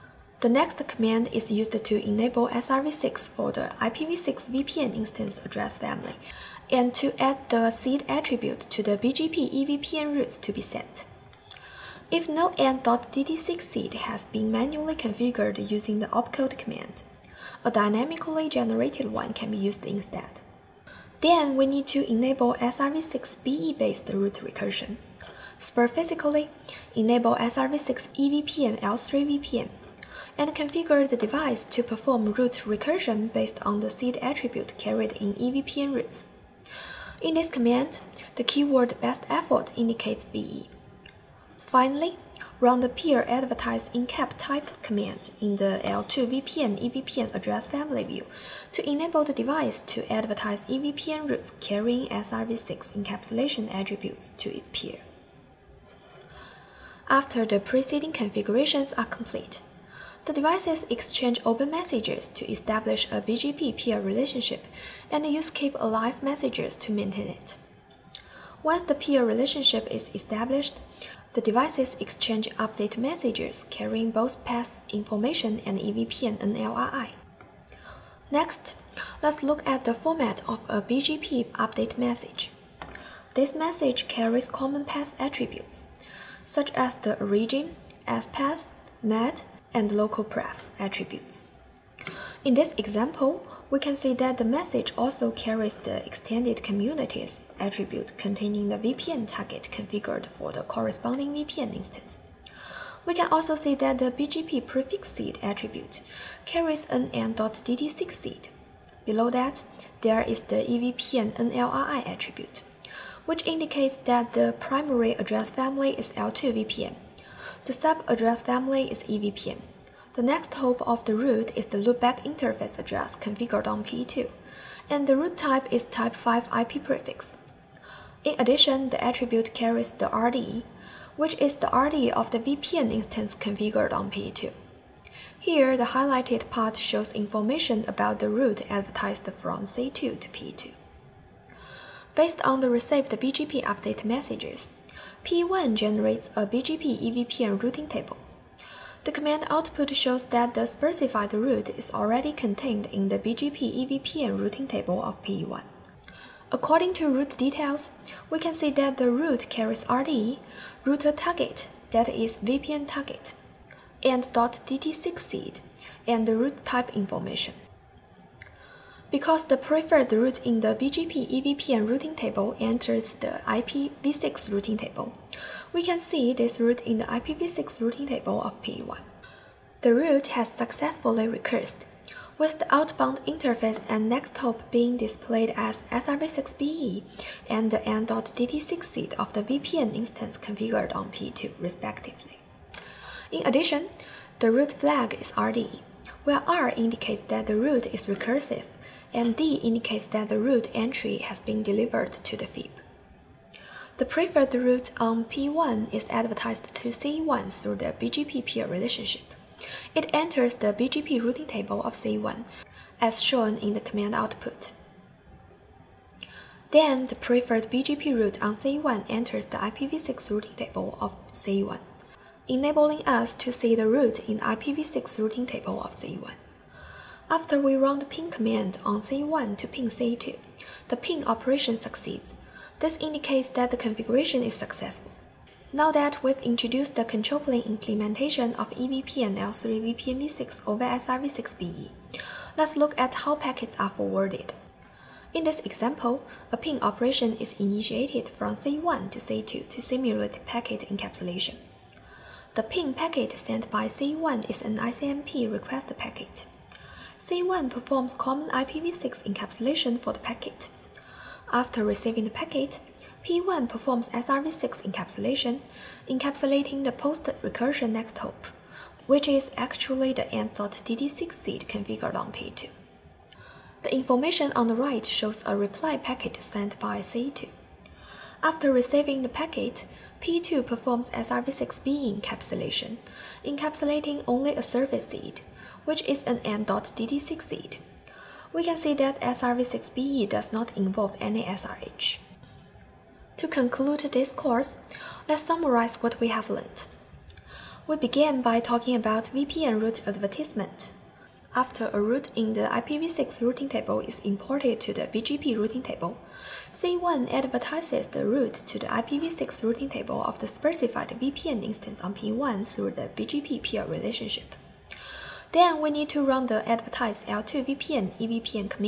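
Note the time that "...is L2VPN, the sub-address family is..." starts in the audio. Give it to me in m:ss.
1:55.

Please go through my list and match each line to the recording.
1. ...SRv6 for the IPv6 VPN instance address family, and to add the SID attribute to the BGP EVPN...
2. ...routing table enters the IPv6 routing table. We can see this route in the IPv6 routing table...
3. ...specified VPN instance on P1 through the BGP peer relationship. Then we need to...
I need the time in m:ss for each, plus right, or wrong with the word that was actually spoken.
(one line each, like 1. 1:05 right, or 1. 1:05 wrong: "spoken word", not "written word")
1. 0:02 right
2. 2:51 right
3. 5:10 right.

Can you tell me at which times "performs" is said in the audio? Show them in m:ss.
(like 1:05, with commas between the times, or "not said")
0:31, 4:17, 4:23, 4:40.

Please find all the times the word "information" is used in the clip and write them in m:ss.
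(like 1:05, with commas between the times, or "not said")
1:14, 2:17, 2:46, 4:33.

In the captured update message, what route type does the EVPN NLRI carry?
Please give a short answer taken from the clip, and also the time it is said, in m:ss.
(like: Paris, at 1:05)
type 5 IP prefix, at 2:05.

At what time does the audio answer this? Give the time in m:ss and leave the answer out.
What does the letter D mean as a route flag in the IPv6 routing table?
3:21.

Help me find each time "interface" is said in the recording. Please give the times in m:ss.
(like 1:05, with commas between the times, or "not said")
2:02, 3:03.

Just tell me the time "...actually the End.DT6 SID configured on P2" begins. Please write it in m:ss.
4:29.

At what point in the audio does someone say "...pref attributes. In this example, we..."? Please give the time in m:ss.
1:30.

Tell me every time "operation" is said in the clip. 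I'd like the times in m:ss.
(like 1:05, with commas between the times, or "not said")
3:51, 4:06.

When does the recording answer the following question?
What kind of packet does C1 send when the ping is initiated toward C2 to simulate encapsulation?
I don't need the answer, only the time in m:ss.
4:14.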